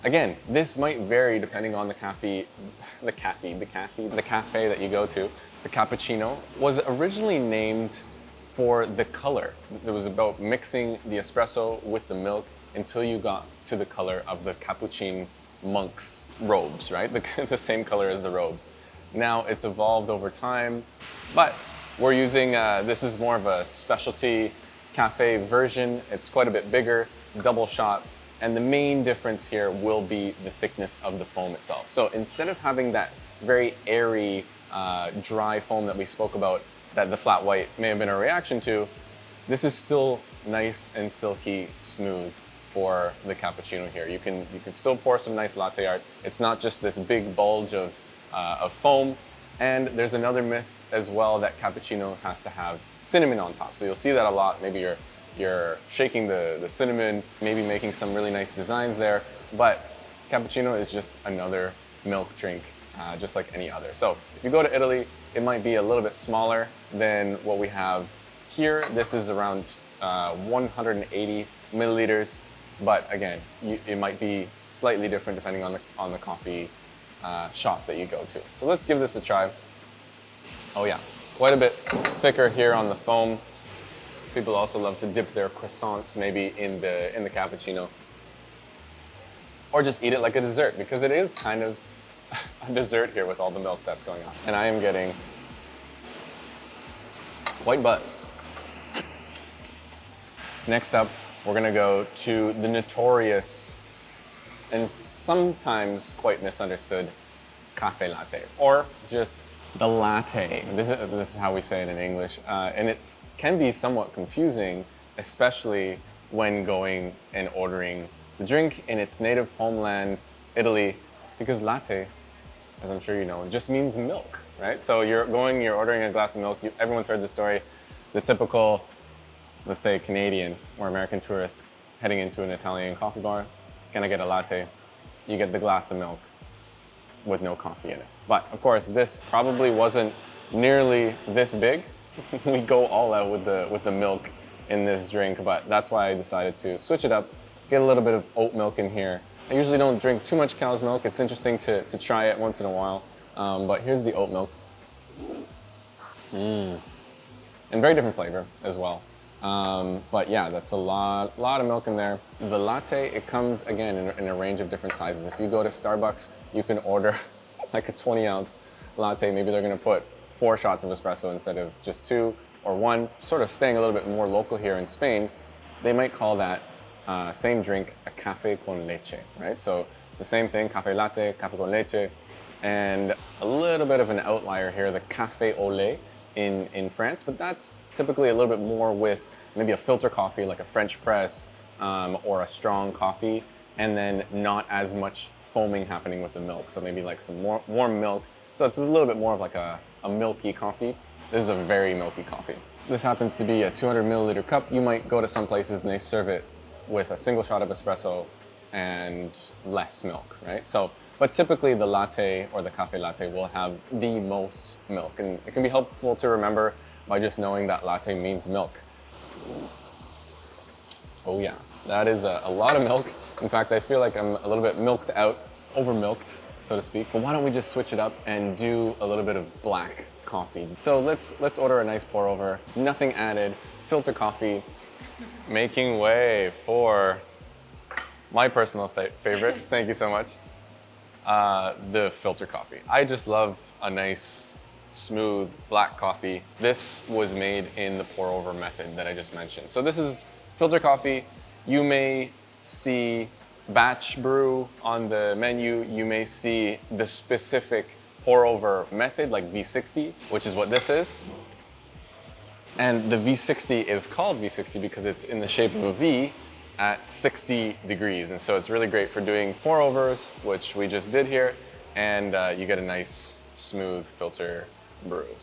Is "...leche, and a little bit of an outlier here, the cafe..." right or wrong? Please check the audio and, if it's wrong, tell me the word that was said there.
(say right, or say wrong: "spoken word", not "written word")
right.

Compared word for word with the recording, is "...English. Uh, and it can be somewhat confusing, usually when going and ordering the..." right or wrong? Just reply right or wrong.
wrong.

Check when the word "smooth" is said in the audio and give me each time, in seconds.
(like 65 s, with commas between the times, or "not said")
41 s, 244 s, 273 s.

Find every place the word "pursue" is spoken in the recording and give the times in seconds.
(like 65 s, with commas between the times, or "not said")
not said.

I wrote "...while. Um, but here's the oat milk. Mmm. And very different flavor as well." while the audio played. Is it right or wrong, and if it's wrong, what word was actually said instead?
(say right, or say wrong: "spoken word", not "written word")
right.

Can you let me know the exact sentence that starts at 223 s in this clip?
In fact, I feel like I'm a little bit milked out, over milked, so to speak.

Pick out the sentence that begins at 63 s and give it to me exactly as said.
So if you go to Italy, it might be a little bit smaller than what we have here.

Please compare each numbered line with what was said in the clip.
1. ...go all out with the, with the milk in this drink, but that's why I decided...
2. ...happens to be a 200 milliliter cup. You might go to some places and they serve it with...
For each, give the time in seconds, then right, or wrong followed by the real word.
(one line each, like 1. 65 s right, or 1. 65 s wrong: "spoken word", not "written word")
1. 142 s right
2. 203 s right.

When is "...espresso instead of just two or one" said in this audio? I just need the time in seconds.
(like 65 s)
170 s.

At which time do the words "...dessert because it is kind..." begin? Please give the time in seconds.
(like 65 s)
90 s.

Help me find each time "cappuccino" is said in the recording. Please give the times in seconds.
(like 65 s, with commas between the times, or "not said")
5 s, 14 s, 43 s, 51 s, 60 s, 87 s.